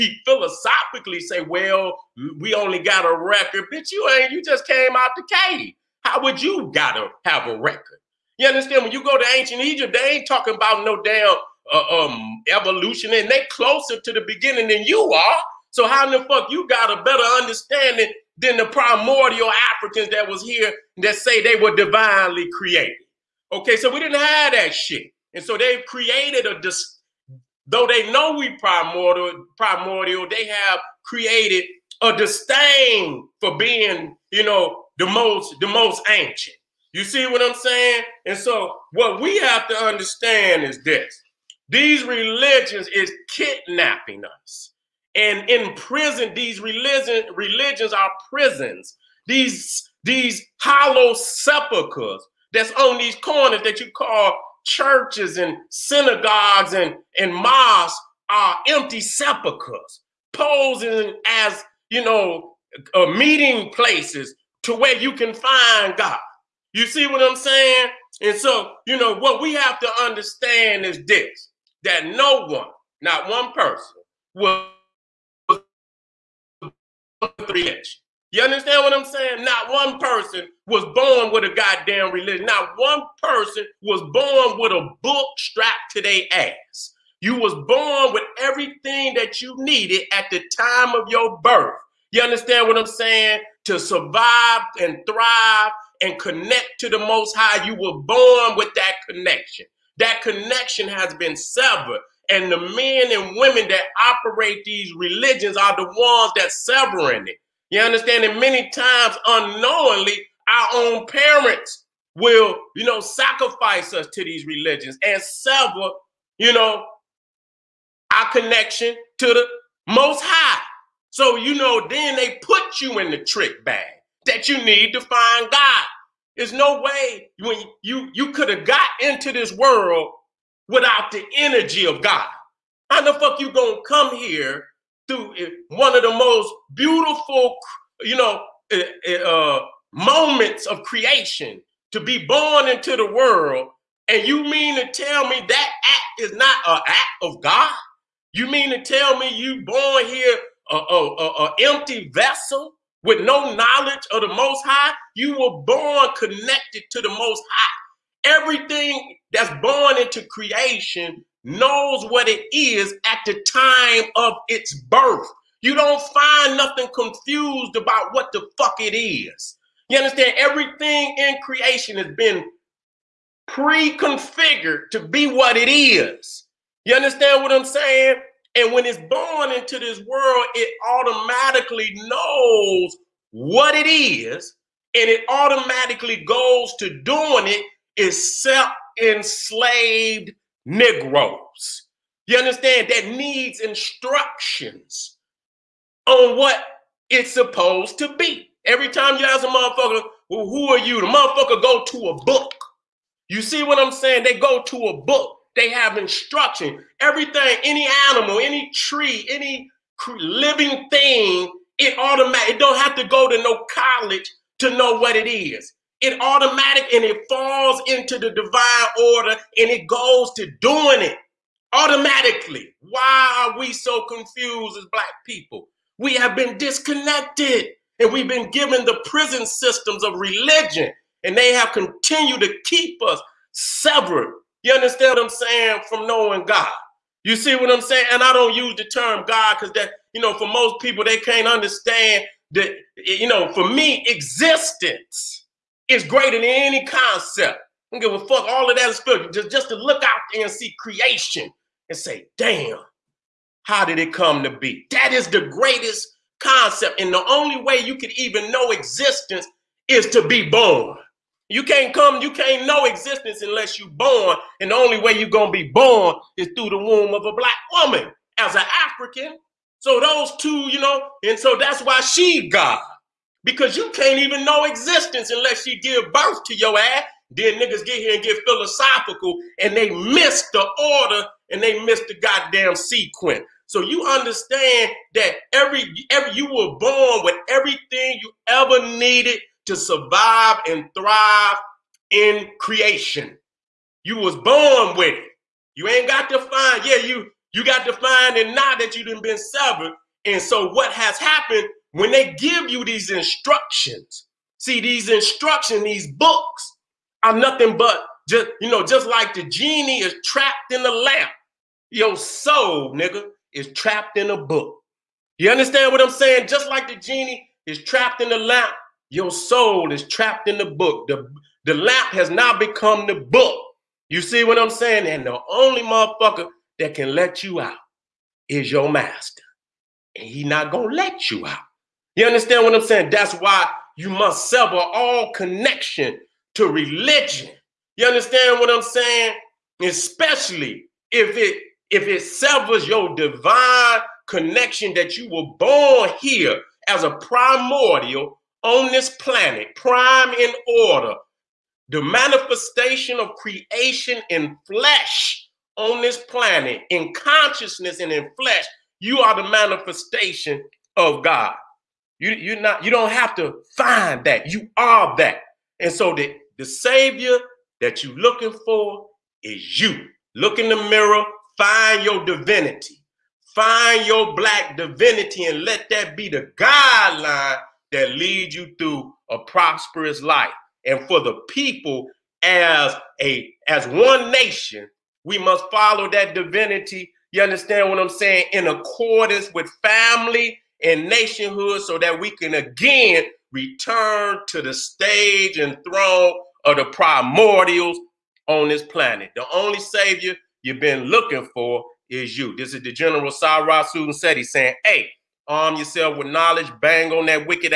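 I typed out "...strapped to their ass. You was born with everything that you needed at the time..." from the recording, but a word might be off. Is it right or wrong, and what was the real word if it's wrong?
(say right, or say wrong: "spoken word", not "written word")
right.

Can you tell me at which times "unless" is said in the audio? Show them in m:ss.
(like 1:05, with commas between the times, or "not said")
4:23, 4:35.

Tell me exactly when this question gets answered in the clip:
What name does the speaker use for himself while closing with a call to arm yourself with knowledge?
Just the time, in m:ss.
6:42.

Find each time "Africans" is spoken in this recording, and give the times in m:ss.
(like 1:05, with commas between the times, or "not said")
0:19, 4:28.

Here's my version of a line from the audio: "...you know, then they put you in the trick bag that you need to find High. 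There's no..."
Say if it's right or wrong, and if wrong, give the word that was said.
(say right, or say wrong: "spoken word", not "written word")
wrong: "God", not "High".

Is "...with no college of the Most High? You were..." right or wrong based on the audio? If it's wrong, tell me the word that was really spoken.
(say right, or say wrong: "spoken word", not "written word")
wrong: "knowledge", not "college".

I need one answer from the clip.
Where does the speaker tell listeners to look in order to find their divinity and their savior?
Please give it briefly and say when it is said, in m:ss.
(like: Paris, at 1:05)
In the mirror, at 6:10.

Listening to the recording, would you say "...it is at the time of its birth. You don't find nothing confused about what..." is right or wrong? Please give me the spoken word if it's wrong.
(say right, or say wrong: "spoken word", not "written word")
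right.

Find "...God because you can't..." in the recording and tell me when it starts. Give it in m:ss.
4:32.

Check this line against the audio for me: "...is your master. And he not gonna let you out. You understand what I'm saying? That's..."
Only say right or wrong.
right.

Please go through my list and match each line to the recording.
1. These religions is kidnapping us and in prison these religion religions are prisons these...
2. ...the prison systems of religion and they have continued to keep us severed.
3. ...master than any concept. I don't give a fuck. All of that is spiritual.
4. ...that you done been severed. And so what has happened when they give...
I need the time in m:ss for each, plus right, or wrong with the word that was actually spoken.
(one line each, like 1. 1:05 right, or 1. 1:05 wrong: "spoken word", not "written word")
1. 0:41 right
2. 3:48 right
3. 4:06 wrong: "greater", not "master"
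4. 4:58 right.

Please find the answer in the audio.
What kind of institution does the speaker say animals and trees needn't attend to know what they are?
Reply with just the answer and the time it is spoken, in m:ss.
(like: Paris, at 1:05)
College, at 3:33.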